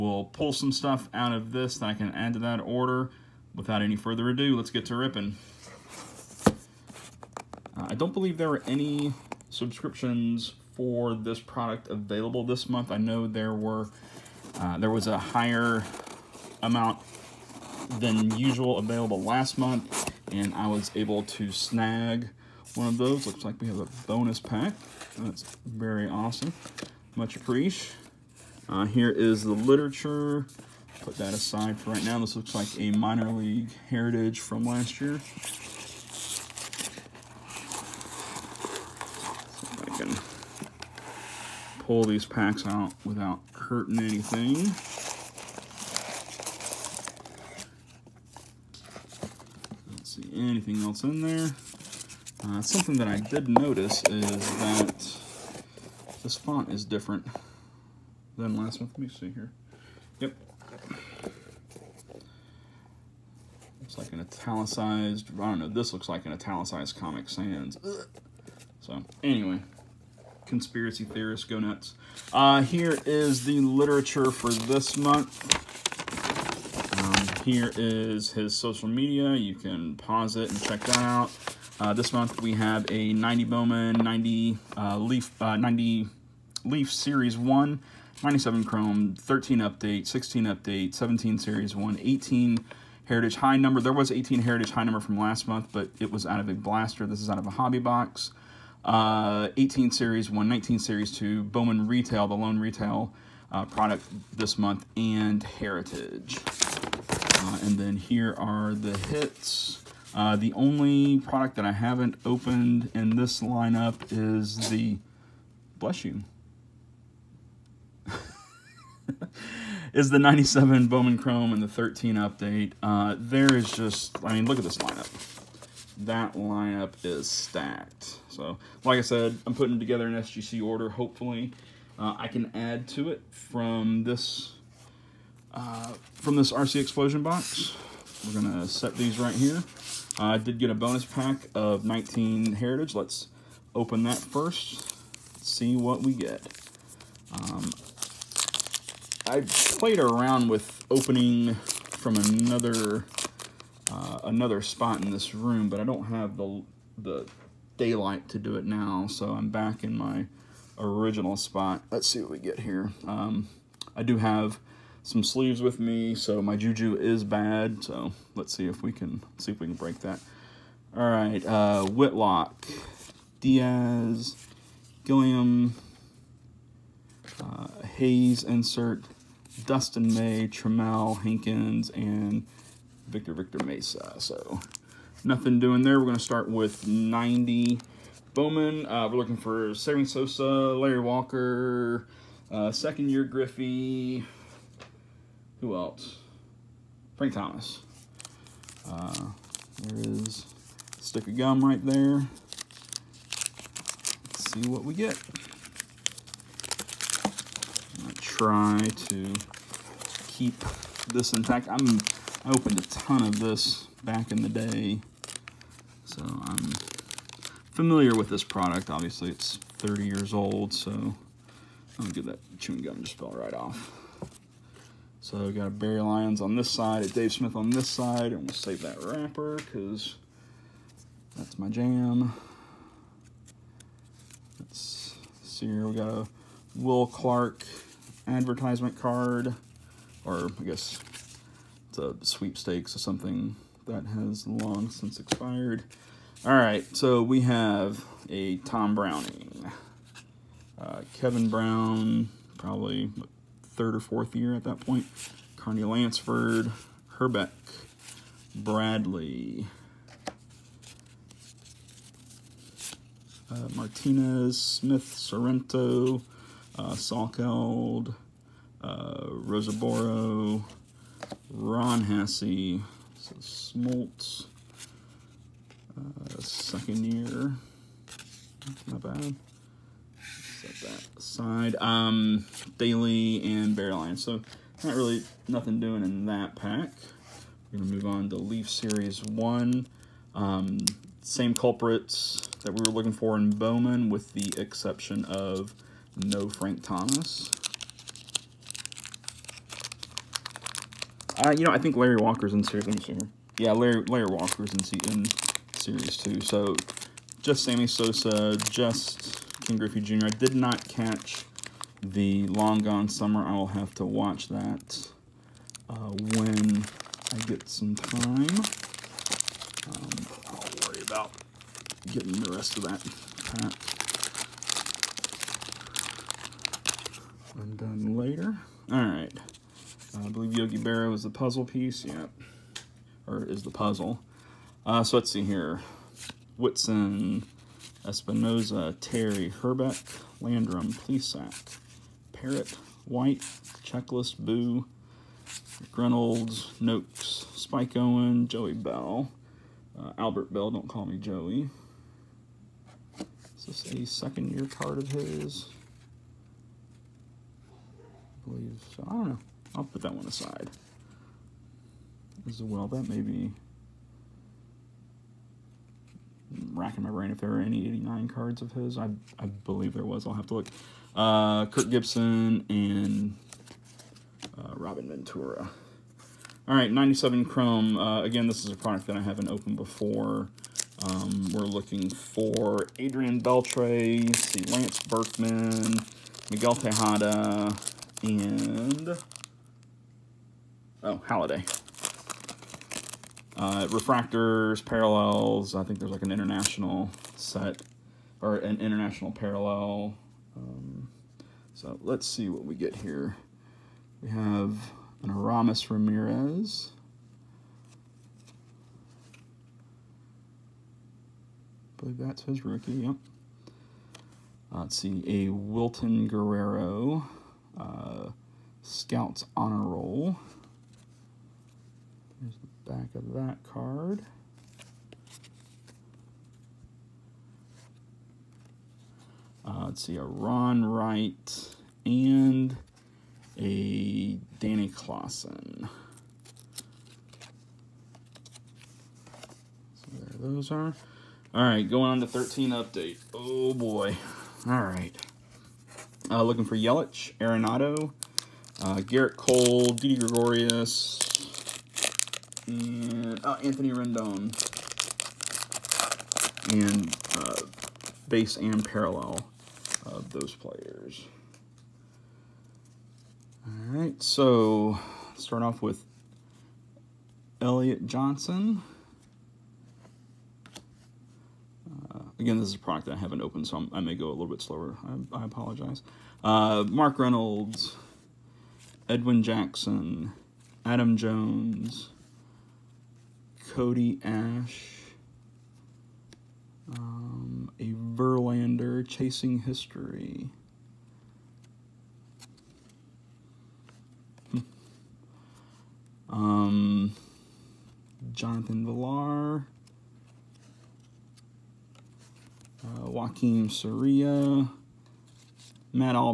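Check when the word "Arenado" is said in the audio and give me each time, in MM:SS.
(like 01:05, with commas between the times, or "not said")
07:27.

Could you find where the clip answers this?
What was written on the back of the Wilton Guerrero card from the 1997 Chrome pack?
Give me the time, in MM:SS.
06:58.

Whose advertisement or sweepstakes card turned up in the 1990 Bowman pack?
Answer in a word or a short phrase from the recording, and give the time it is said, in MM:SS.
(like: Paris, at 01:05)
Will Clark, at 03:56.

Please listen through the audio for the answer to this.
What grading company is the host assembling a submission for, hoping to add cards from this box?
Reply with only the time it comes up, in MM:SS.
02:10.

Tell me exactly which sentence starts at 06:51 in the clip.
I believe that's his rookie, yep.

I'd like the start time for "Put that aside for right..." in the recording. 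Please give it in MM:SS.
00:31.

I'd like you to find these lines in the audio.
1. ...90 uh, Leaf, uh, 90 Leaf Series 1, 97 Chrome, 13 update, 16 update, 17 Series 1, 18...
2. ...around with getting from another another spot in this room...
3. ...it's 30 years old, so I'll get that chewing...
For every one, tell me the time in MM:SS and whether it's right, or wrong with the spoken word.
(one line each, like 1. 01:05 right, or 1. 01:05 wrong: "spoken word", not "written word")
1. 01:23 right
2. 02:29 wrong: "opening", not "getting"
3. 03:39 right.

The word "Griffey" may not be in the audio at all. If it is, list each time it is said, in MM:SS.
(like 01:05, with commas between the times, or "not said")
03:13, 05:09.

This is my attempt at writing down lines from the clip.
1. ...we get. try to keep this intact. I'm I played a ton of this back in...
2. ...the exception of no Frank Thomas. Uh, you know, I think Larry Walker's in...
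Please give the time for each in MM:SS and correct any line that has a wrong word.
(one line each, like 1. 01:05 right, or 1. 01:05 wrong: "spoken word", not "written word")
1. 03:24 wrong: "opened", not "played"
2. 04:54 right.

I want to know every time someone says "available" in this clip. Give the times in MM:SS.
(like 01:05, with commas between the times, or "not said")
00:11, 00:18.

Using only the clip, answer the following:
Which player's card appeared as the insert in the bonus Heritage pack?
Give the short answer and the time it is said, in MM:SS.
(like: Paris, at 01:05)
Hayes, at 02:57.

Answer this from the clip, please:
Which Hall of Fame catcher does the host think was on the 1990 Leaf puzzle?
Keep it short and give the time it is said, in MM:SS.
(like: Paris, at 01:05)
Yogi Berra, at 05:30.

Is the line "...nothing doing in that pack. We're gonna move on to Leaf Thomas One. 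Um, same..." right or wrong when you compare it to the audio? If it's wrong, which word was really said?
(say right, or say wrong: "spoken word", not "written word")
wrong: "Series", not "Thomas".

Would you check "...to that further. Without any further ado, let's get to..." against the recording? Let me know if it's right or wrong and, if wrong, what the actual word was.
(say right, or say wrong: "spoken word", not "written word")
wrong: "order", not "further".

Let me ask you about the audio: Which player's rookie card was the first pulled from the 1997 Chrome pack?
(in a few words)
Aramis Ramirez.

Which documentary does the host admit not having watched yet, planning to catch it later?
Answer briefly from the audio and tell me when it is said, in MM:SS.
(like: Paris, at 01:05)
Long Gone Summer, at 05:12.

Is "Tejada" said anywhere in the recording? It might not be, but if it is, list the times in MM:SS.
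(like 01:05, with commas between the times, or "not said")
06:26.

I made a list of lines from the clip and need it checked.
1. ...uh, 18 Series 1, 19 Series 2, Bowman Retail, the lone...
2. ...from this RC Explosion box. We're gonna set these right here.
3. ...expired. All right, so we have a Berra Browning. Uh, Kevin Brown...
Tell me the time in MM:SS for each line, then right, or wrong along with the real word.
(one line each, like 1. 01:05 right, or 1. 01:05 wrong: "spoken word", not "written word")
1. 01:38 right
2. 02:16 right
3. 04:05 wrong: "Tom", not "Berra".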